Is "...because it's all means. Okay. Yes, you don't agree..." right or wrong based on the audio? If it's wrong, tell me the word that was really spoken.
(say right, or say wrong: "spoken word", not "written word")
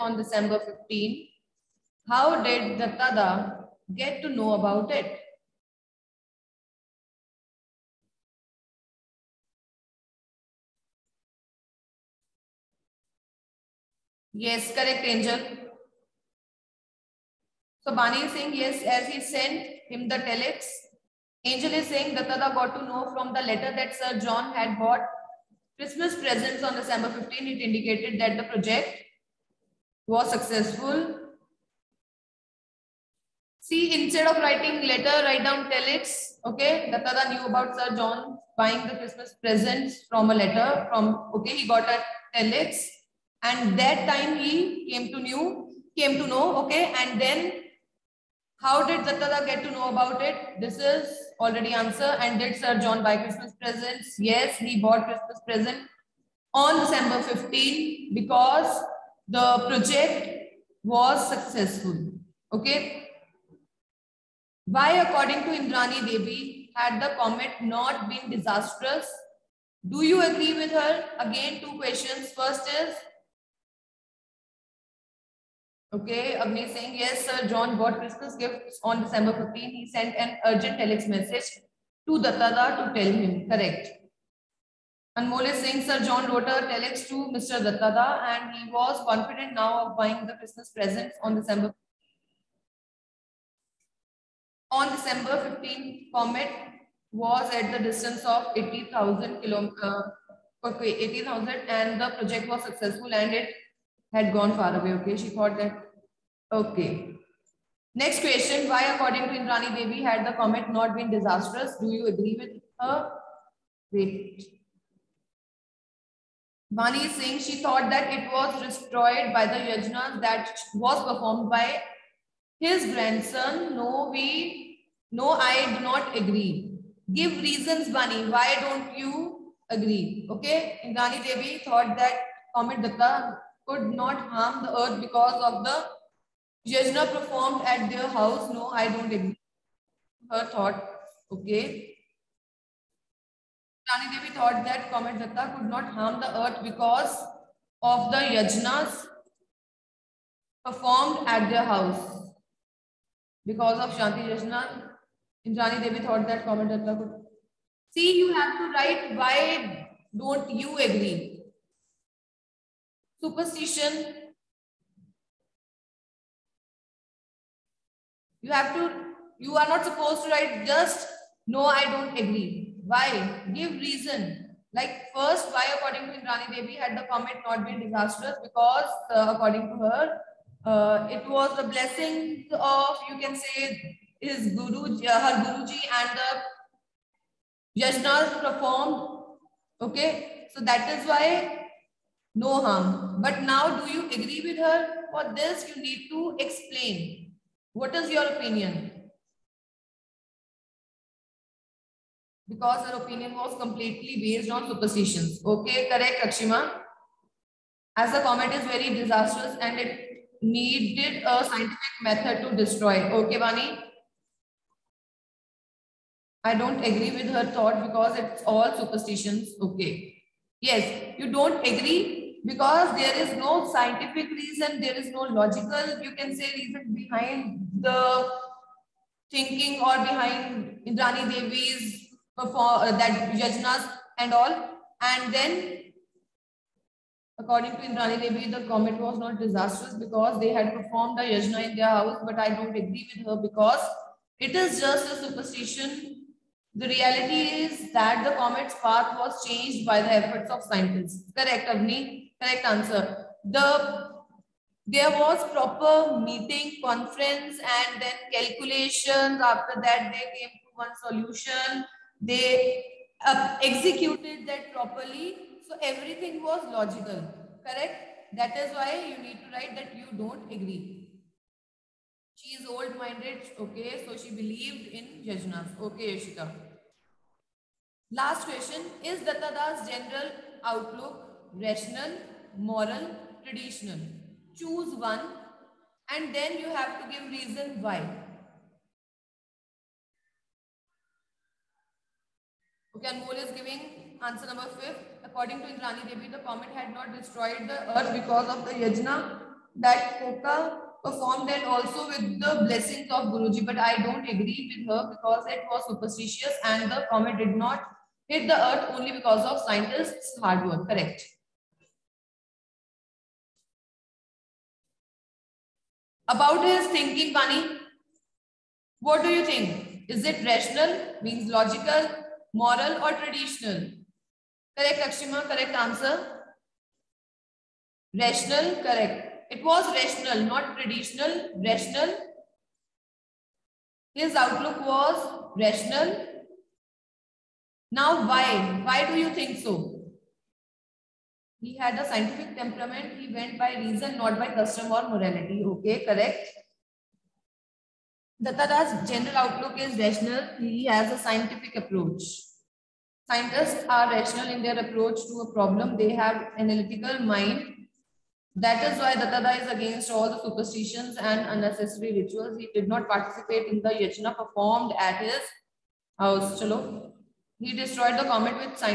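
wrong: "superstitions", not "means".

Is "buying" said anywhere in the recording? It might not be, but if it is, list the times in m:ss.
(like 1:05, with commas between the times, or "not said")
0:38, 1:29.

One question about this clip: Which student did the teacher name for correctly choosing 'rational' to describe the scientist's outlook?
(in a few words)
Lakshima.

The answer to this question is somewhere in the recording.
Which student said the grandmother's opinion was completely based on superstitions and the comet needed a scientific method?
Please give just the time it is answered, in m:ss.
3:26.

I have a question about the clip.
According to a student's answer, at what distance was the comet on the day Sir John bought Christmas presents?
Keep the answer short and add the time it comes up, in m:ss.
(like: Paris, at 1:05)
80,000 kilometers, at 1:38.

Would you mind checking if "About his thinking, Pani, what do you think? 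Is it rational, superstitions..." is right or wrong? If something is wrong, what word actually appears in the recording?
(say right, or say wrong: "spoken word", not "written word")
wrong: "means", not "superstitions".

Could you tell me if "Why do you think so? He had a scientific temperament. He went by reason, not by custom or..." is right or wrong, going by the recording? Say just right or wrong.
right.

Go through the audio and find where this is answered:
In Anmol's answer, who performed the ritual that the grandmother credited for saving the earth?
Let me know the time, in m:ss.
5:00.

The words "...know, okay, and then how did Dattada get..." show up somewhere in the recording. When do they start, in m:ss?
0:46.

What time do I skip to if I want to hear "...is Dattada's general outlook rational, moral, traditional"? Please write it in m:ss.
4:39.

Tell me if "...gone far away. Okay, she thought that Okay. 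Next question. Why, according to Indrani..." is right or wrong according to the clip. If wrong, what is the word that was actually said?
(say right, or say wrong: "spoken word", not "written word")
right.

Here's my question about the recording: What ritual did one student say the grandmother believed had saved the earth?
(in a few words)
Shanti Yajna.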